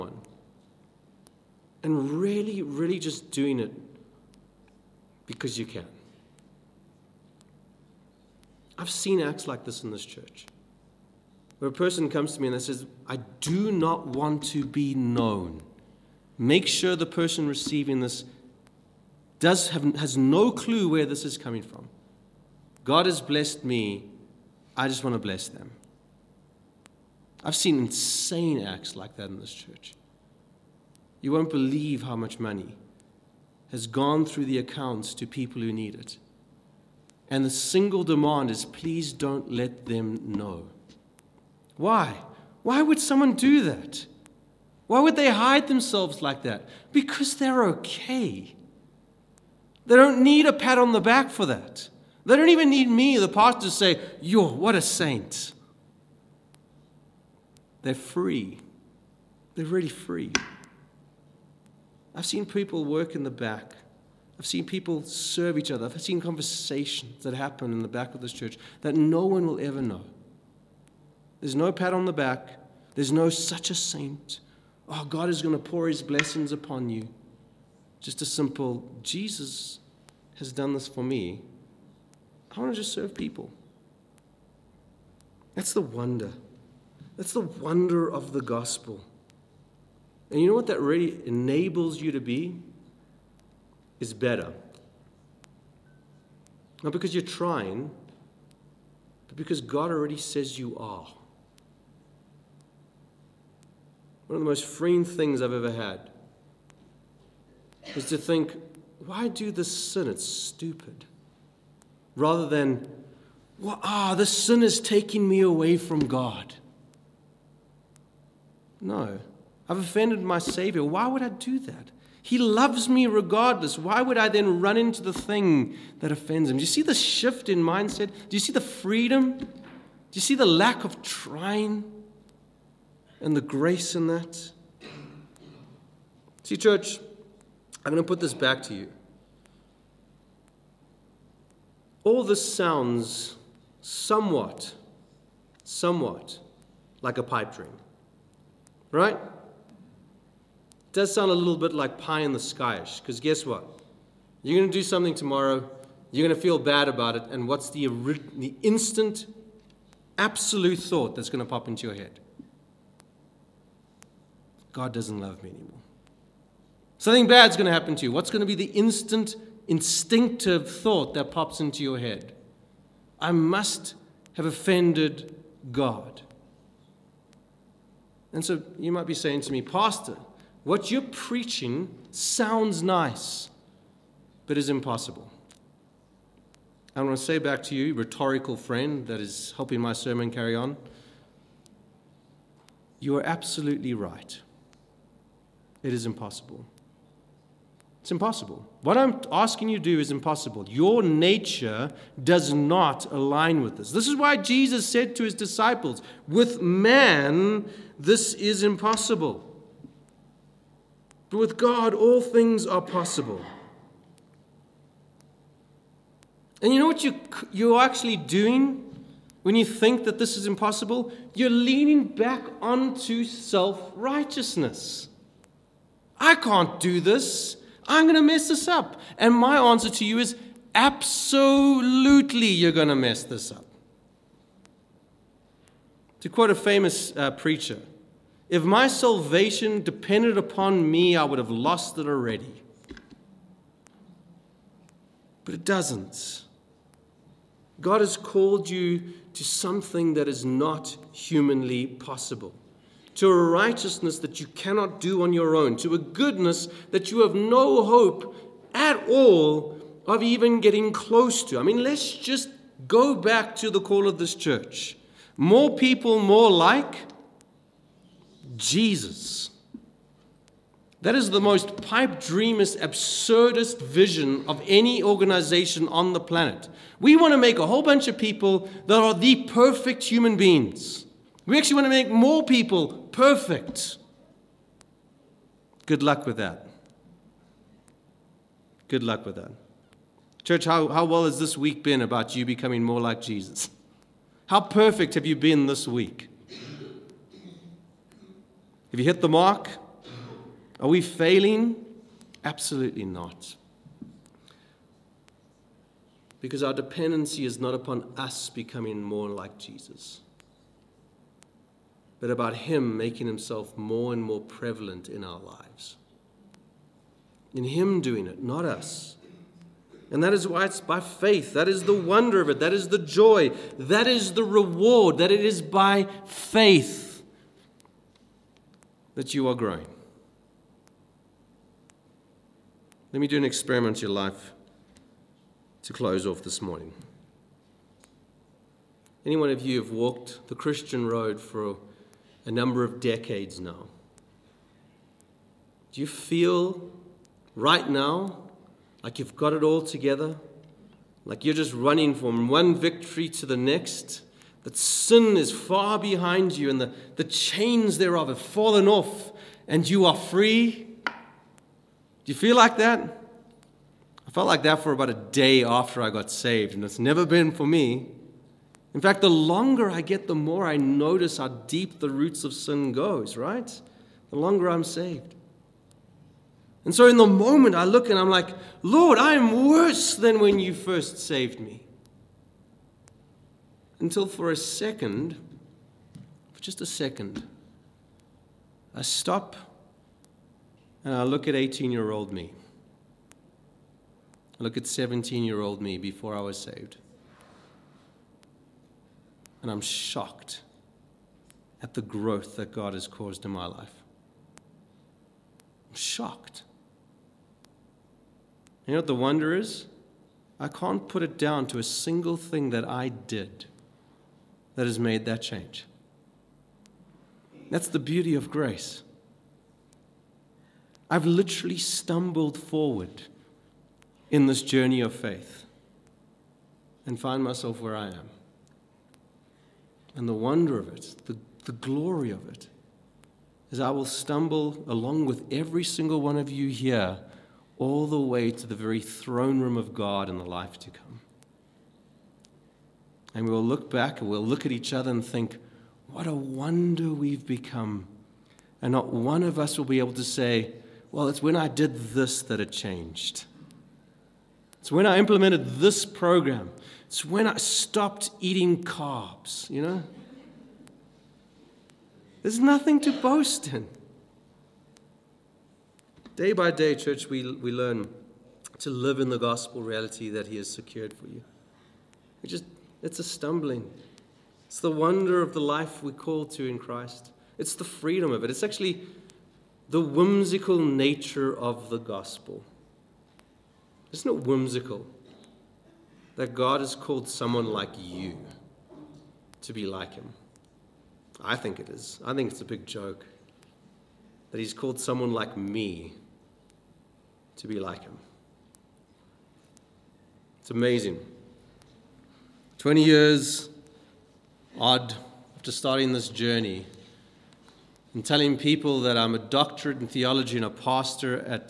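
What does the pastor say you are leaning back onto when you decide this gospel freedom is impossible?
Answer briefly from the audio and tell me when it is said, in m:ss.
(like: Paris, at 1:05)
Self righteousness, at 3:43.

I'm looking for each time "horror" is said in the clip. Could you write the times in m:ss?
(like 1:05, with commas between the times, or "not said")
not said.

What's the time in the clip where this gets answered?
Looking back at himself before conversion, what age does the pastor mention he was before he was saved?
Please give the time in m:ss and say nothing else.
6:34.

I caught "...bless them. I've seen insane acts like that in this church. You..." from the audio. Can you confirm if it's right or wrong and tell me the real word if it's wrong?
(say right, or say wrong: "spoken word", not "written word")
right.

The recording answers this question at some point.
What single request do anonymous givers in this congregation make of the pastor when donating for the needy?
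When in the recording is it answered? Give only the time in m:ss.
0:38.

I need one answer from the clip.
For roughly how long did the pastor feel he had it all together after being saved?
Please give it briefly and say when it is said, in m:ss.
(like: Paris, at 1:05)
About a day, at 6:04.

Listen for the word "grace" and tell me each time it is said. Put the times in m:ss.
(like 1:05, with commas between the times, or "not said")
2:13, 6:58.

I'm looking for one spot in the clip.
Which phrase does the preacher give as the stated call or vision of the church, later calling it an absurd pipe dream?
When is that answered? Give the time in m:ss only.
4:25.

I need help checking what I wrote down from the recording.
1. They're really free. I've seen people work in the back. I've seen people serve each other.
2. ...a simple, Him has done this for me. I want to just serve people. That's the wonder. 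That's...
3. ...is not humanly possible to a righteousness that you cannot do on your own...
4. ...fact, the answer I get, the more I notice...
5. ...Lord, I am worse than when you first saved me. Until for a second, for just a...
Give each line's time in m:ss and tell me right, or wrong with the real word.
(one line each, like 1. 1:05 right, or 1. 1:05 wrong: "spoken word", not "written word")
1. 0:59 right
2. 1:18 wrong: "Jesus", not "Him"
3. 4:10 right
4. 6:09 wrong: "longer", not "answer"
5. 6:18 right.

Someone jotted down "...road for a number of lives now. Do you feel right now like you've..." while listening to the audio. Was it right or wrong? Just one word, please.
wrong.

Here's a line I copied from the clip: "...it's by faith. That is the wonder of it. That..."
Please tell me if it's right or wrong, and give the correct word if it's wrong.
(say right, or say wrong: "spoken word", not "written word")
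right.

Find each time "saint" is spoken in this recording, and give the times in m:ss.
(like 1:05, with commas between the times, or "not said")
0:54, 1:13.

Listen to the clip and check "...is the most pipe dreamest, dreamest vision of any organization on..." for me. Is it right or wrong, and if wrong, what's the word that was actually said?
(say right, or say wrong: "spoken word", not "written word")
wrong: "absurdist", not "dreamest".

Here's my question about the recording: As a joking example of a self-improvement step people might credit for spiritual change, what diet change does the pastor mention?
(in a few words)
Stopped eating carbs.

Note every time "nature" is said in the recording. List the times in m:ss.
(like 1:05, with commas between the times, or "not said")
3:21, 8:00.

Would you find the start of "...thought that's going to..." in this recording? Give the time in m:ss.
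2:40.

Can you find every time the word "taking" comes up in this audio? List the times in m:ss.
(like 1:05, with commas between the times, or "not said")
1:54.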